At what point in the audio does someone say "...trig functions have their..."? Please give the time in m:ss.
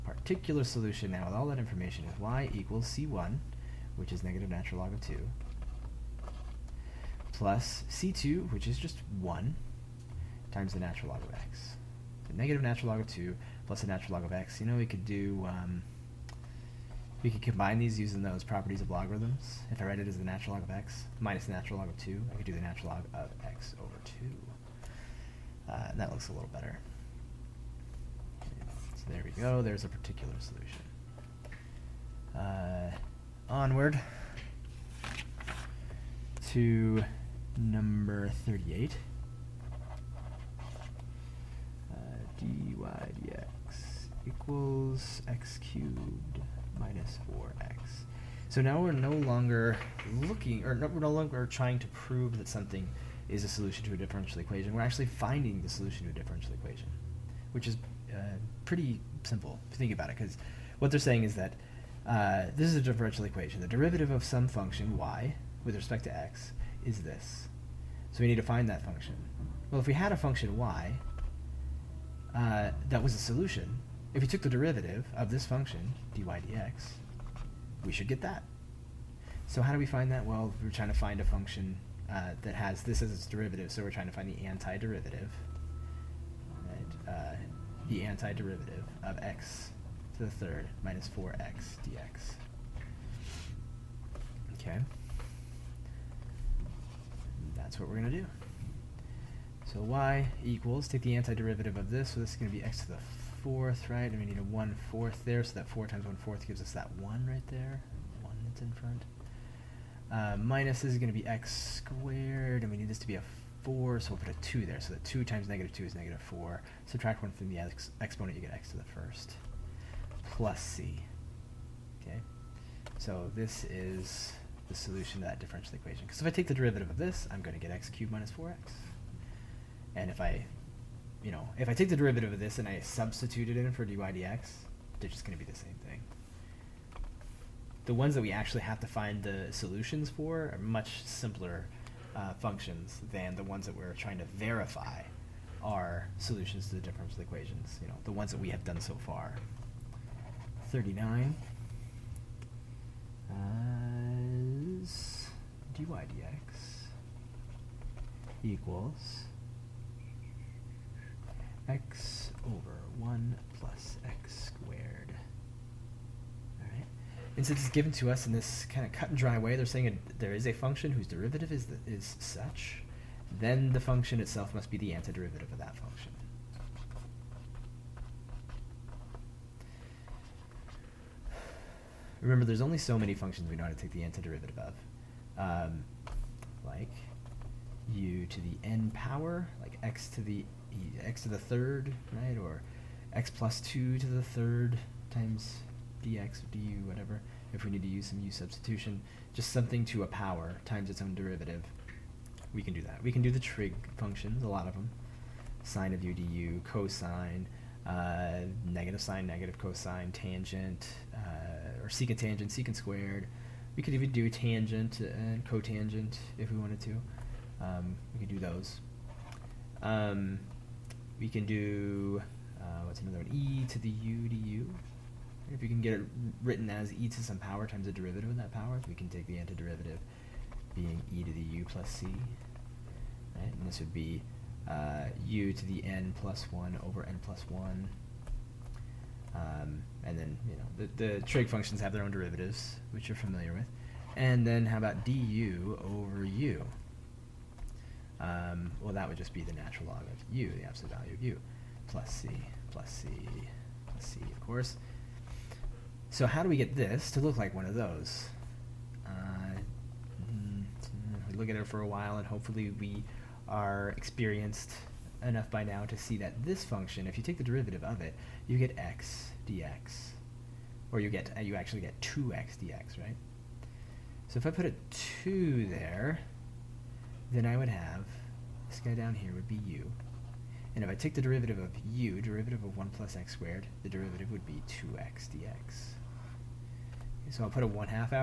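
4:01.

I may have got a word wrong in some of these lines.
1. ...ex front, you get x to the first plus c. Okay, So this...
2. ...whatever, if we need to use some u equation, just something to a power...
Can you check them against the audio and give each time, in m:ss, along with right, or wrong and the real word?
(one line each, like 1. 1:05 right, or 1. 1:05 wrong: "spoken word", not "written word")
1. 1:57 wrong: "exponent", not "front"
2. 3:16 wrong: "substitution", not "equation".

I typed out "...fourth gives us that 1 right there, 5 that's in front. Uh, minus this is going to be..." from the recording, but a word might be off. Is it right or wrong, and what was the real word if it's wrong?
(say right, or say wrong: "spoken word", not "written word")
wrong: "1", not "5".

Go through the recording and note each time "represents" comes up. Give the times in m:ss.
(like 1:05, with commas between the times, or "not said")
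not said.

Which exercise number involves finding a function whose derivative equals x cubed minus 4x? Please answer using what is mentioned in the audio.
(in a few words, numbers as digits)
38.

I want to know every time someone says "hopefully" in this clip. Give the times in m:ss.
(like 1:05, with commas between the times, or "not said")
4:22.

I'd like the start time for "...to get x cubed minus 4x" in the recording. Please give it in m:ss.
2:07.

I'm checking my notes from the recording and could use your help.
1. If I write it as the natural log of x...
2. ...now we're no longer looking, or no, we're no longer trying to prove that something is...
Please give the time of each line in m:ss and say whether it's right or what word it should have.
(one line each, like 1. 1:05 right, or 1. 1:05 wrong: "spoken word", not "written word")
1. 0:19 right
2. 0:48 right.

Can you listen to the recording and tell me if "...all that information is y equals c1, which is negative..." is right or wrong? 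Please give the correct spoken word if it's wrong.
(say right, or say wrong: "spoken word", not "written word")
right.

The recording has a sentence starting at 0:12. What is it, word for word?
The negative natural log of 2 plus the natural log of x.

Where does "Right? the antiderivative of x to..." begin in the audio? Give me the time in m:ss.
1:26.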